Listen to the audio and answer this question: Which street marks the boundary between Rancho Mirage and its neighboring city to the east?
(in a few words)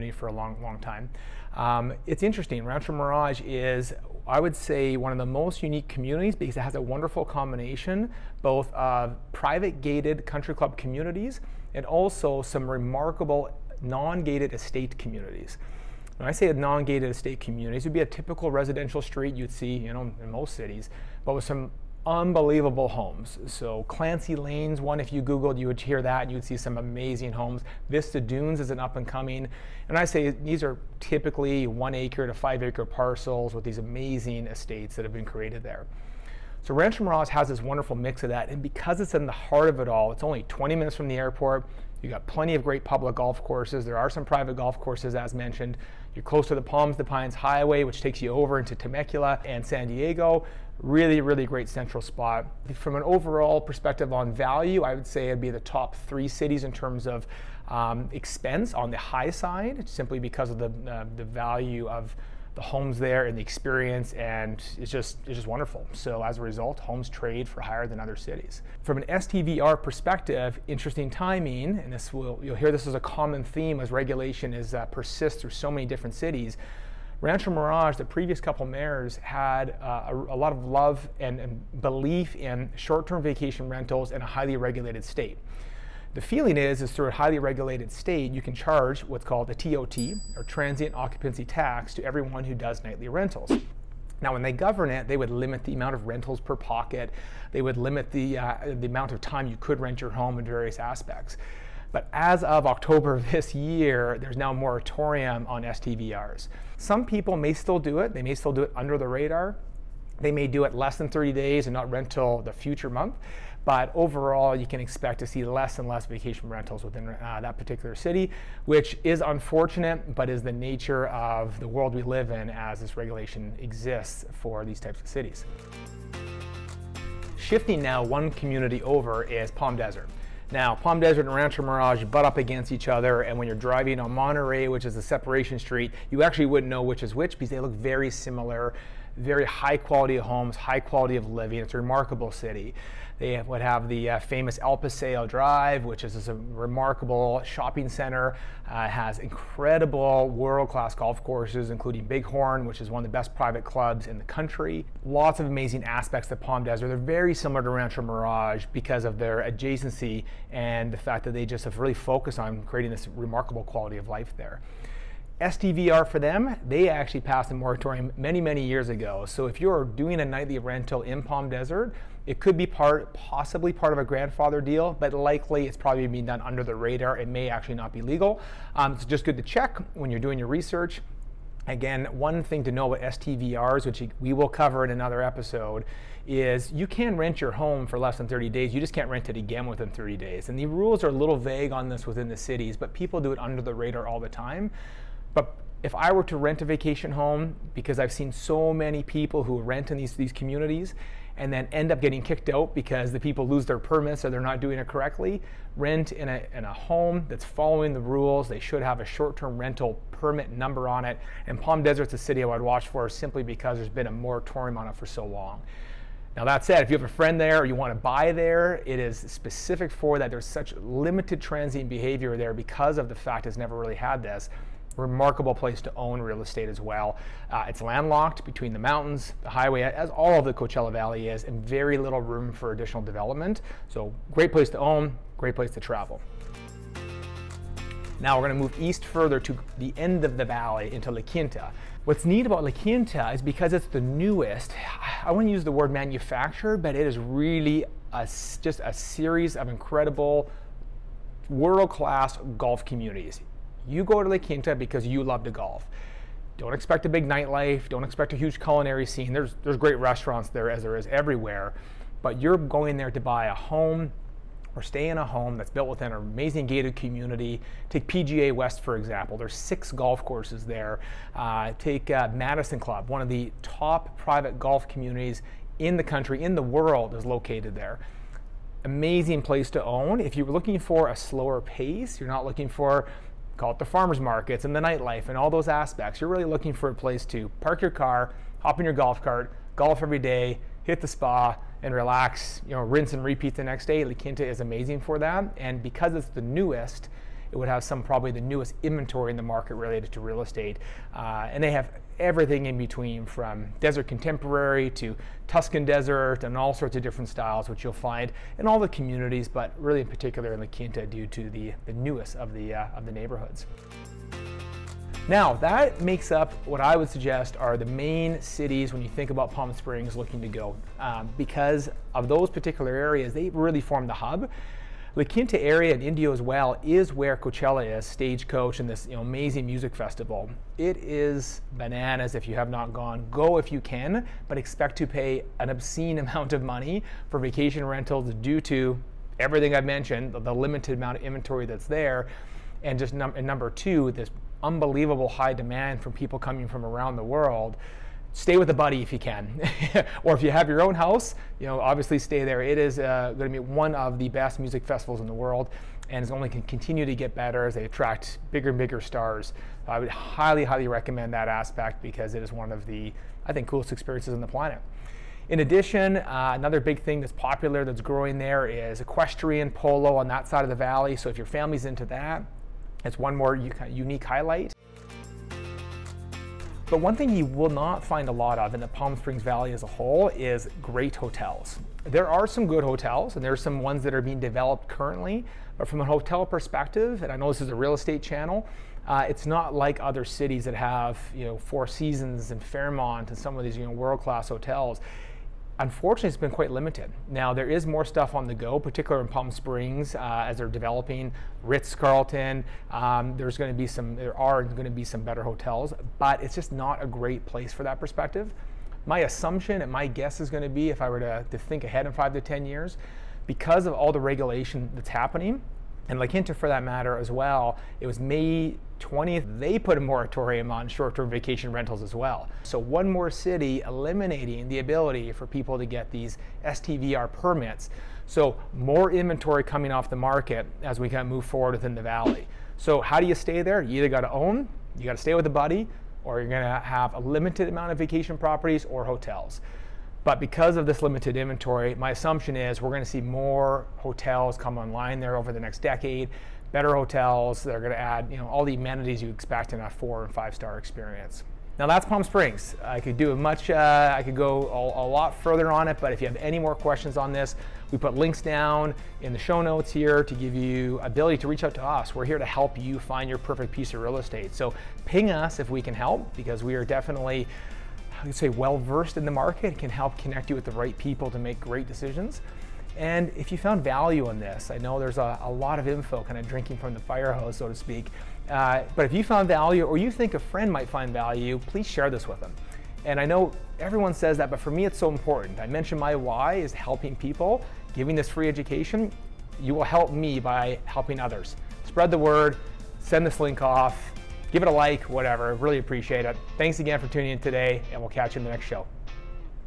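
Monterey.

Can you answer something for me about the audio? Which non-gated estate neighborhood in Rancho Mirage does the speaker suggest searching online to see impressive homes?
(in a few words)
Clancy Lanes.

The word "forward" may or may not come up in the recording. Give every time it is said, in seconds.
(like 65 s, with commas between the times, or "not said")
431 s.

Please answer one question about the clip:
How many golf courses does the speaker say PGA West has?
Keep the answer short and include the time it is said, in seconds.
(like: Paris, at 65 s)
6, at 269 s.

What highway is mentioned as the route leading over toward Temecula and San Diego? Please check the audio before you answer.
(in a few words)
Palms to Pines Highway.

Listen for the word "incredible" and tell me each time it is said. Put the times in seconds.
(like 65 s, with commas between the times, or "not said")
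149 s, 249 s.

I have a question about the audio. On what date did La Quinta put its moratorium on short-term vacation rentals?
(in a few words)
May 20th.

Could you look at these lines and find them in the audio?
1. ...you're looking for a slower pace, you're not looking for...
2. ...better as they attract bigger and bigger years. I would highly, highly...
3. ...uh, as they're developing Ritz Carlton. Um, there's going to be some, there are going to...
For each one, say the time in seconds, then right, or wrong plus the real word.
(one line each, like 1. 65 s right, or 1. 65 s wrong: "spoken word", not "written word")
1. 280 s right
2. 357 s wrong: "stars", not "years"
3. 400 s right.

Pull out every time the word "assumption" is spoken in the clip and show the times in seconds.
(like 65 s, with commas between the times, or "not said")
409 s, 442 s.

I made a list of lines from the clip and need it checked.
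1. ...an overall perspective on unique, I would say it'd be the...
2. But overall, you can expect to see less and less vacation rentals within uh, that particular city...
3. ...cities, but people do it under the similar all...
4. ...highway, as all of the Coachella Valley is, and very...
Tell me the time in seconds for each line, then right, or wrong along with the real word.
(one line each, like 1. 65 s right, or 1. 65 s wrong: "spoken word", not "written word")
1. 52 s wrong: "value", not "unique"
2. 113 s right
3. 192 s wrong: "radar", not "similar"
4. 229 s right.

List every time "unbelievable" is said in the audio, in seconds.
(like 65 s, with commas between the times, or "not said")
22 s, 344 s.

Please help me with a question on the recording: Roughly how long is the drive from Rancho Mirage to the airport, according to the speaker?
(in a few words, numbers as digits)
20 minutes.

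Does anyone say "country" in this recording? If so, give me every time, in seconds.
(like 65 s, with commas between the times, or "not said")
10 s, 154 s, 276 s.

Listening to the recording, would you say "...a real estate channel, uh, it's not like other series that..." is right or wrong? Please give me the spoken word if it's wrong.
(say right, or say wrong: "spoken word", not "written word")
wrong: "cities", not "series".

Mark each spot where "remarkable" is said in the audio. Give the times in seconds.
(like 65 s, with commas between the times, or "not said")
12 s, 141 s, 146 s, 163 s, 224 s.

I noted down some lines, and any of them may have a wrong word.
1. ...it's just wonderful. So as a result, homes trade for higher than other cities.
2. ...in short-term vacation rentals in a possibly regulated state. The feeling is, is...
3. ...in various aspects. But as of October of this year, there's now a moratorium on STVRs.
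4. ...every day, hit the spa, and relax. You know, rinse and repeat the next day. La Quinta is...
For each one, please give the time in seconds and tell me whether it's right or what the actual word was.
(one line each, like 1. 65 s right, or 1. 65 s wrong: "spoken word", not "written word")
1. 65 s right
2. 82 s wrong: "highly", not "possibly"
3. 100 s right
4. 290 s right.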